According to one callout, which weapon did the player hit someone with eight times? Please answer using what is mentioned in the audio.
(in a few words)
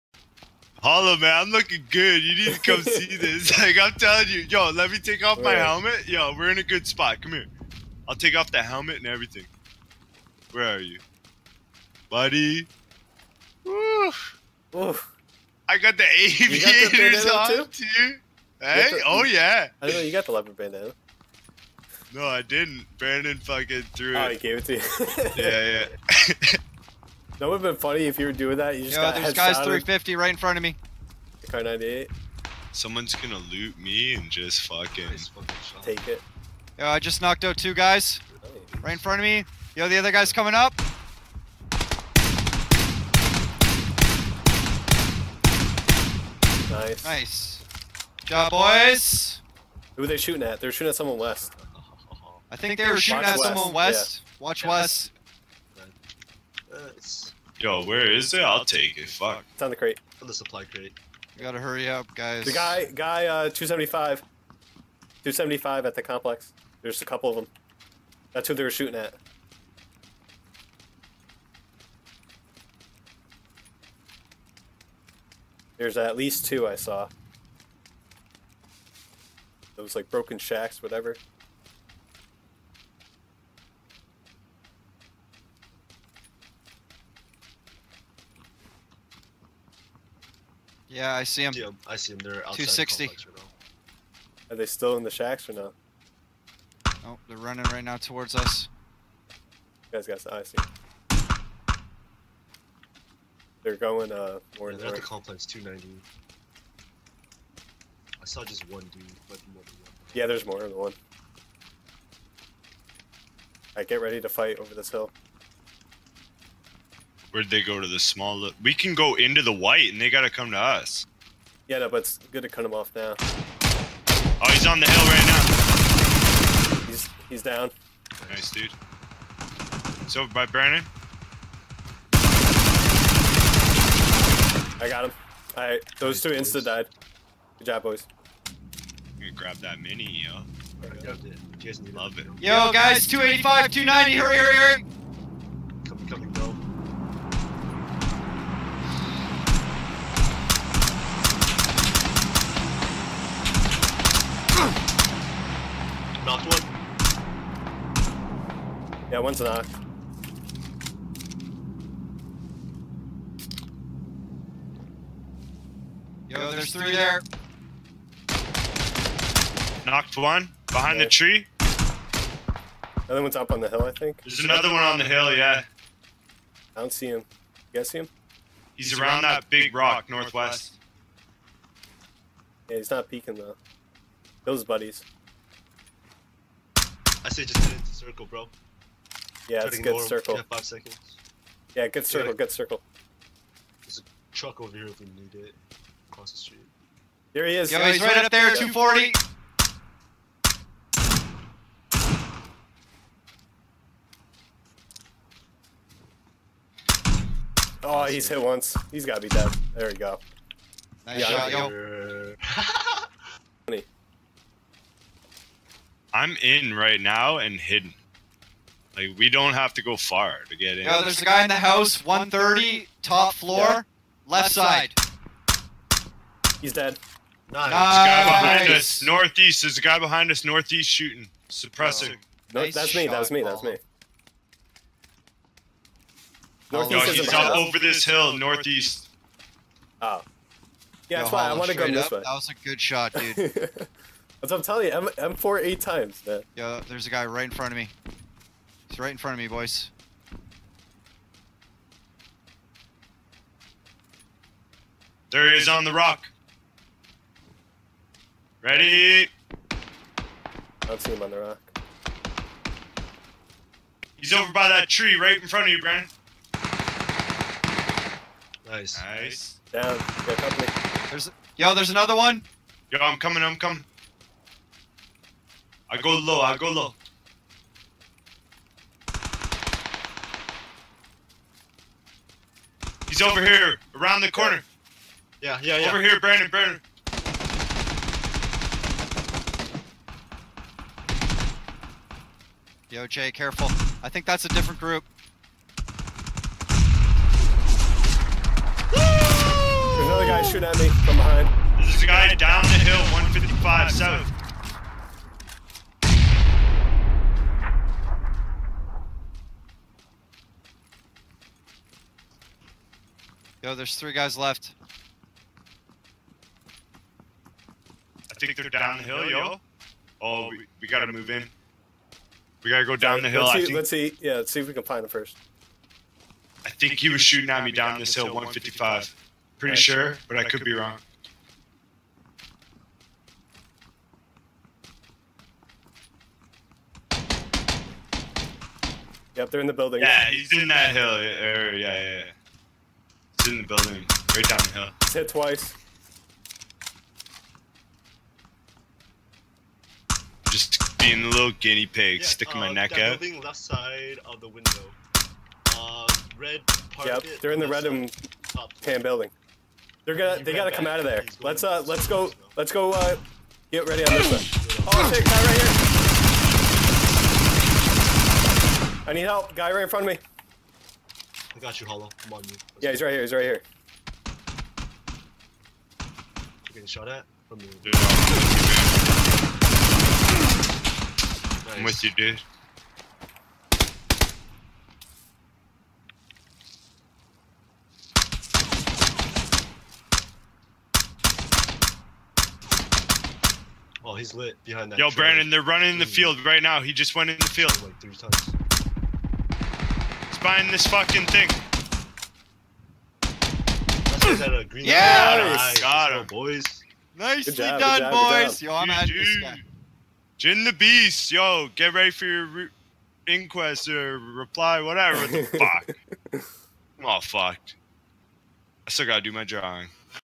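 M4.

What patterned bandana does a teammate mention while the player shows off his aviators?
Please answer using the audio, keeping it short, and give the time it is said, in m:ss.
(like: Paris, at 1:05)
leopard, at 0:20.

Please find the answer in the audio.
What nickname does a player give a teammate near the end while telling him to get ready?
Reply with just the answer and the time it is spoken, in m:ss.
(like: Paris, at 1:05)
Jin the Beast, at 6:50.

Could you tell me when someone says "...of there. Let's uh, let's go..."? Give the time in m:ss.
6:00.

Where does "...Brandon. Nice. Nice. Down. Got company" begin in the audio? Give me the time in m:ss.
4:25.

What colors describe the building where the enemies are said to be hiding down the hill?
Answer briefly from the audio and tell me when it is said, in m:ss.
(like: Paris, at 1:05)
red and tan, at 5:57.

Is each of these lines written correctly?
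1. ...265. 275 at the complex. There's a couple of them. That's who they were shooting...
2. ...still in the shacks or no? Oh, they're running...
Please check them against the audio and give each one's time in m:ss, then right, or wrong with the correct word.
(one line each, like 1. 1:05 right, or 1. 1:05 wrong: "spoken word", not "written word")
1. 1:03 wrong: "275", not "265"
2. 1:34 right.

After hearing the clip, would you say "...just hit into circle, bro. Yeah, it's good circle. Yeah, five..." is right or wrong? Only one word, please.
right.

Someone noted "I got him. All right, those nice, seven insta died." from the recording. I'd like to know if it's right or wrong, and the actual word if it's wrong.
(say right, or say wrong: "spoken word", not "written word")
wrong: "two", not "seven".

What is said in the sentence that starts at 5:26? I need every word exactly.
I think he was shooting at me down this hill, 155.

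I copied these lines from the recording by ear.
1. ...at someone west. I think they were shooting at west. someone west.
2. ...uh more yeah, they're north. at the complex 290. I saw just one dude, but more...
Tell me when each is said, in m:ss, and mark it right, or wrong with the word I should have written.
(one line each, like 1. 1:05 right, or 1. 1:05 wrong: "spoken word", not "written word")
1. 0:50 right
2. 1:44 right.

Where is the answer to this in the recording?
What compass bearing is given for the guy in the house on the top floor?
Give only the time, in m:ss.
3:42.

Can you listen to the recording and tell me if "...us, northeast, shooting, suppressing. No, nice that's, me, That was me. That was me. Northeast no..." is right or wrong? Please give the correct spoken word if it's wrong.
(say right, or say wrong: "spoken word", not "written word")
right.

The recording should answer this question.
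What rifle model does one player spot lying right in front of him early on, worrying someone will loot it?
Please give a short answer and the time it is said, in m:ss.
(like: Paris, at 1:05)
Kar98, at 0:31.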